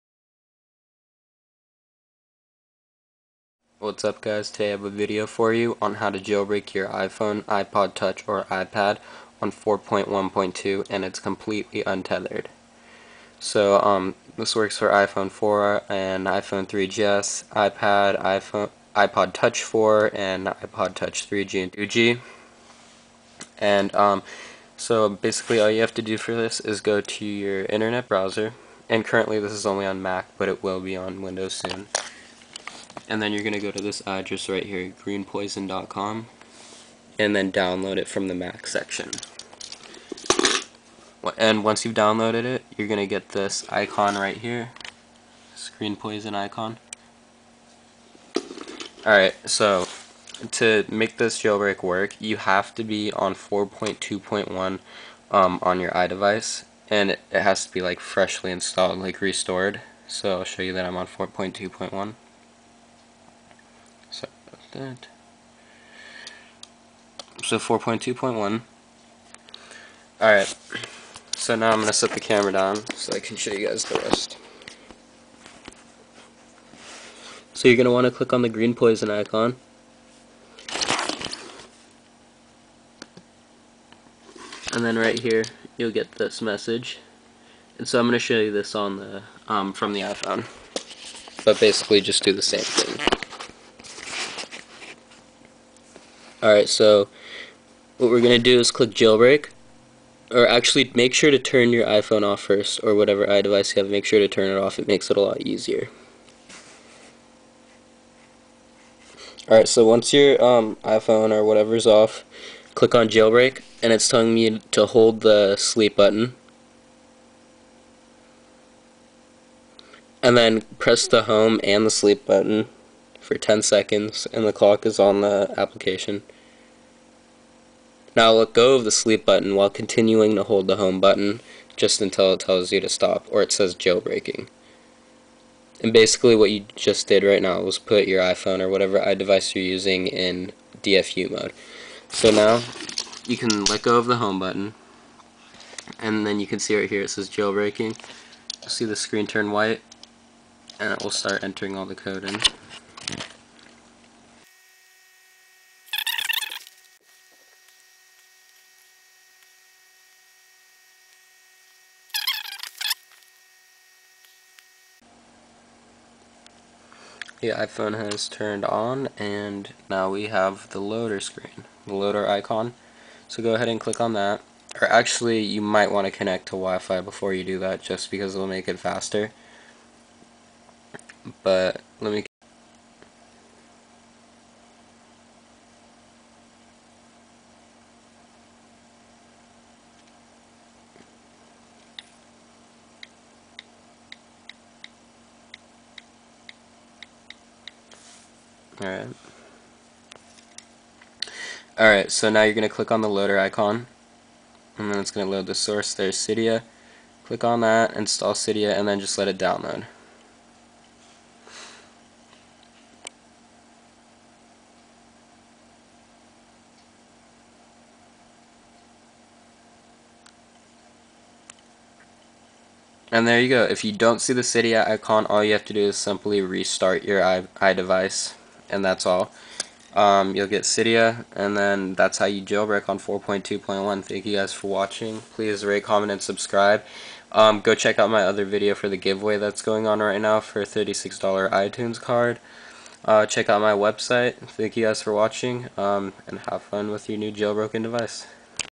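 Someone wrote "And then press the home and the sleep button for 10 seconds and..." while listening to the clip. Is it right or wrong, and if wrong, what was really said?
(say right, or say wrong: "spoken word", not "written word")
right.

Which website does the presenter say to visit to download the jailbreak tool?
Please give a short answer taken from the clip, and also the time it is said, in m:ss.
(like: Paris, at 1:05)
greenpois0n.com, at 0:35.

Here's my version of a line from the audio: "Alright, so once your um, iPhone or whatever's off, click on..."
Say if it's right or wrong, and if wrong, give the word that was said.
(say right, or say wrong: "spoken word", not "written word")
right.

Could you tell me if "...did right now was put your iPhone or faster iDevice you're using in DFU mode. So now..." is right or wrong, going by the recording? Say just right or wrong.
wrong.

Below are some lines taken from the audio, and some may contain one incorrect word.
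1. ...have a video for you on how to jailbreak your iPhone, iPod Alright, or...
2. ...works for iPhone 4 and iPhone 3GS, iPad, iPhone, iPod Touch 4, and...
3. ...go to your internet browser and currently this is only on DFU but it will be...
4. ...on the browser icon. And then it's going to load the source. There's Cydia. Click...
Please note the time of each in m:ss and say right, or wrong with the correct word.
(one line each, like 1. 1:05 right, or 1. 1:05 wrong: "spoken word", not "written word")
1. 0:04 wrong: "Touch", not "Alright"
2. 0:14 right
3. 0:26 wrong: "Mac", not "DFU"
4. 3:22 wrong: "loader", not "browser".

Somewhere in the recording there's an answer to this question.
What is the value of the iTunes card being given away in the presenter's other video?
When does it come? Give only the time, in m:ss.
4:00.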